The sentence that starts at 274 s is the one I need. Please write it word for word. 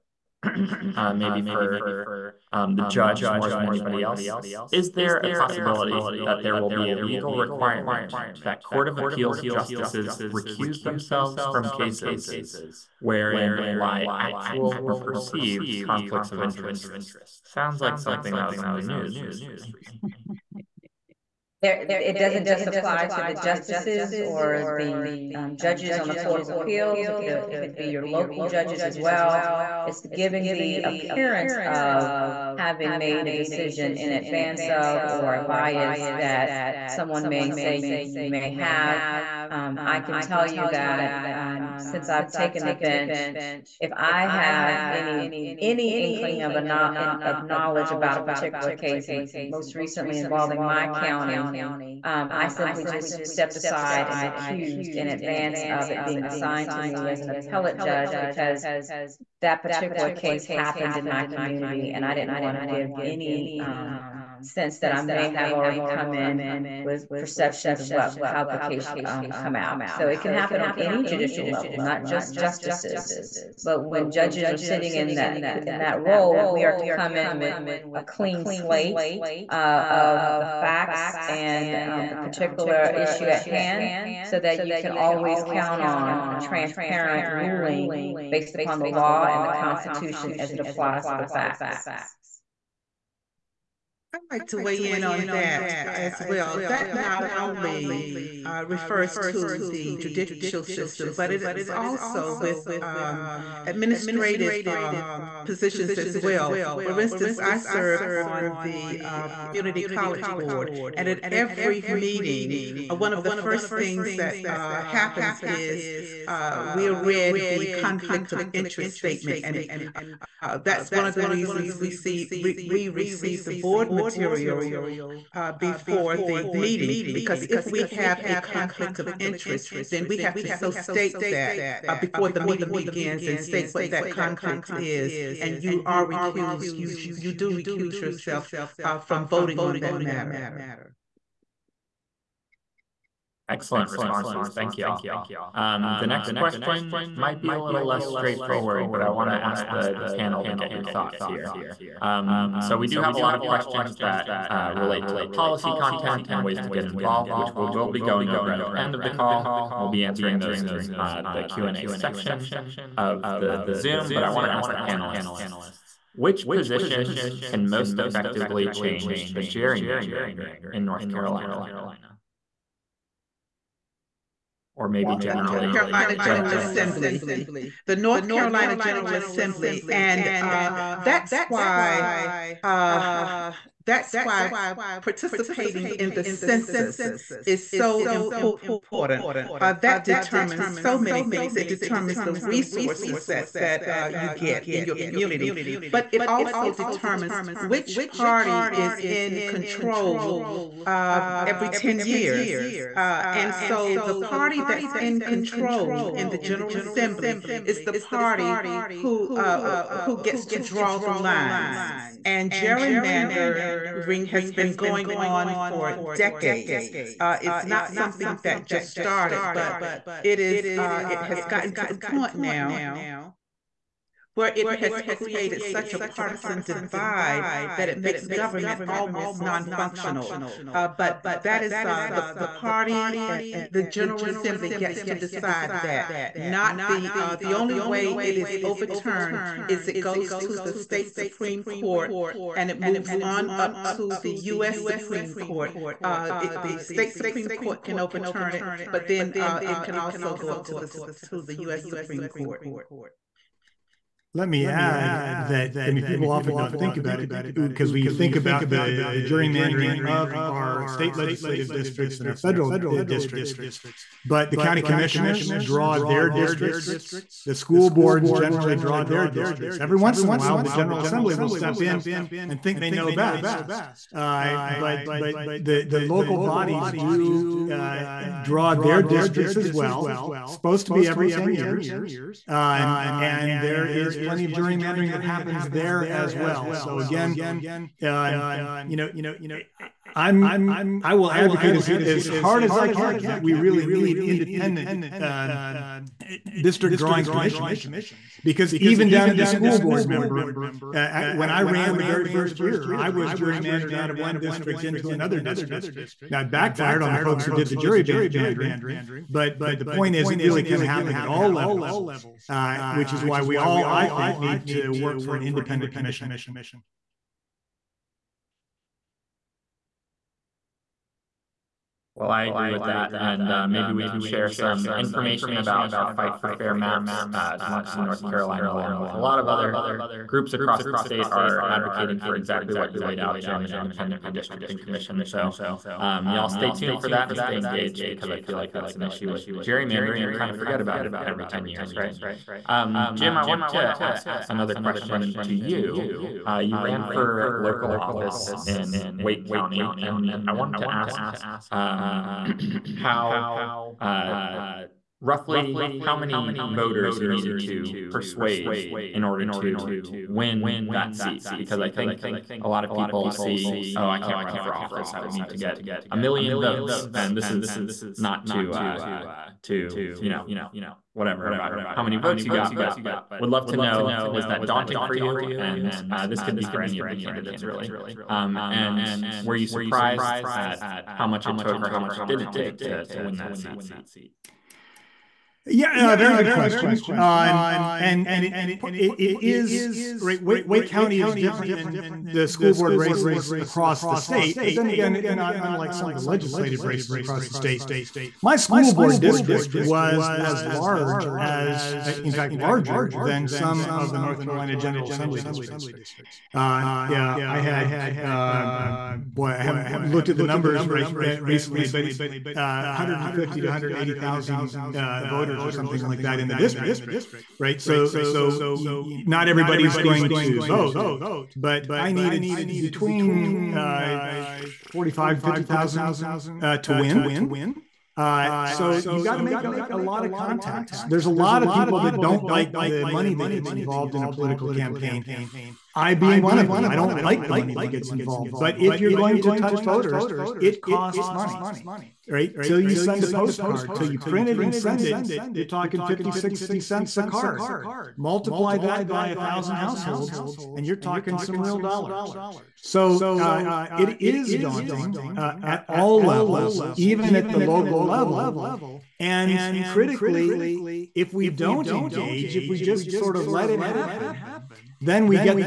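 Uh, but but the the local bodies do uh, draw their districts as well.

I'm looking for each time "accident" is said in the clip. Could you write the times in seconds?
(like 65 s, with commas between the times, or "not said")
not said.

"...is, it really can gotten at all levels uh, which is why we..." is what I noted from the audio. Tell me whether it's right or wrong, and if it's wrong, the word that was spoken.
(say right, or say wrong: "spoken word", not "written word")
wrong: "happen", not "gotten".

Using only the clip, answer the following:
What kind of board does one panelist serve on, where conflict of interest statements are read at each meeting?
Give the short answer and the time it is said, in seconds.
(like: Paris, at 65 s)
community college board, at 109 s.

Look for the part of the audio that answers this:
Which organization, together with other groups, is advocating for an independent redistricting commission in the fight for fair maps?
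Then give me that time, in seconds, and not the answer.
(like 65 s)
327 s.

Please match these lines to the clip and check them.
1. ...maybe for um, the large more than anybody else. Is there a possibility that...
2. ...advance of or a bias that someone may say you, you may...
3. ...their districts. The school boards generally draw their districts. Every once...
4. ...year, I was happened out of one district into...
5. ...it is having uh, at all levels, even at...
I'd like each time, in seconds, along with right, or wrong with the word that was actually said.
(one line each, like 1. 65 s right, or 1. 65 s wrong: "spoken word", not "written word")
1. 1 s wrong: "judge", not "large"
2. 34 s right
3. 265 s right
4. 302 s wrong: "gerrymandered", not "happened"
5. 453 s wrong: "daunting", not "having".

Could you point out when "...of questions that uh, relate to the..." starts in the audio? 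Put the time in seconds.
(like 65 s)
153 s.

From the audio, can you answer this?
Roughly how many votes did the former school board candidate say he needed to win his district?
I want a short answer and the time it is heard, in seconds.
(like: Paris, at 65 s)
45,000 to 50,000, at 424 s.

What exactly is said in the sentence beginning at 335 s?
So um, y'all stay tuned for that and stay engaged because I feel like that's an issue with gerrymandering.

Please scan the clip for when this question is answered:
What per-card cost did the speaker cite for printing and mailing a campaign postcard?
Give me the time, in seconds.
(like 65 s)
446 s.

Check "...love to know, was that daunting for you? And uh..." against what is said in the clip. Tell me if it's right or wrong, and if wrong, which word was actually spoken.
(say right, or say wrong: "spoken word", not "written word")
right.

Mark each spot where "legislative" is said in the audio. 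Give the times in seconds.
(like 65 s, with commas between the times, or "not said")
261 s, 396 s.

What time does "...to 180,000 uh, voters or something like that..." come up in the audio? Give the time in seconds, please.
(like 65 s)
413 s.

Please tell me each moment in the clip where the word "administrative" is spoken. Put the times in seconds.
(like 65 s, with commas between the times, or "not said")
103 s.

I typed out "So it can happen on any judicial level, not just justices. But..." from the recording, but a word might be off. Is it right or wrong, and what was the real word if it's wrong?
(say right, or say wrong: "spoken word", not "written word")
right.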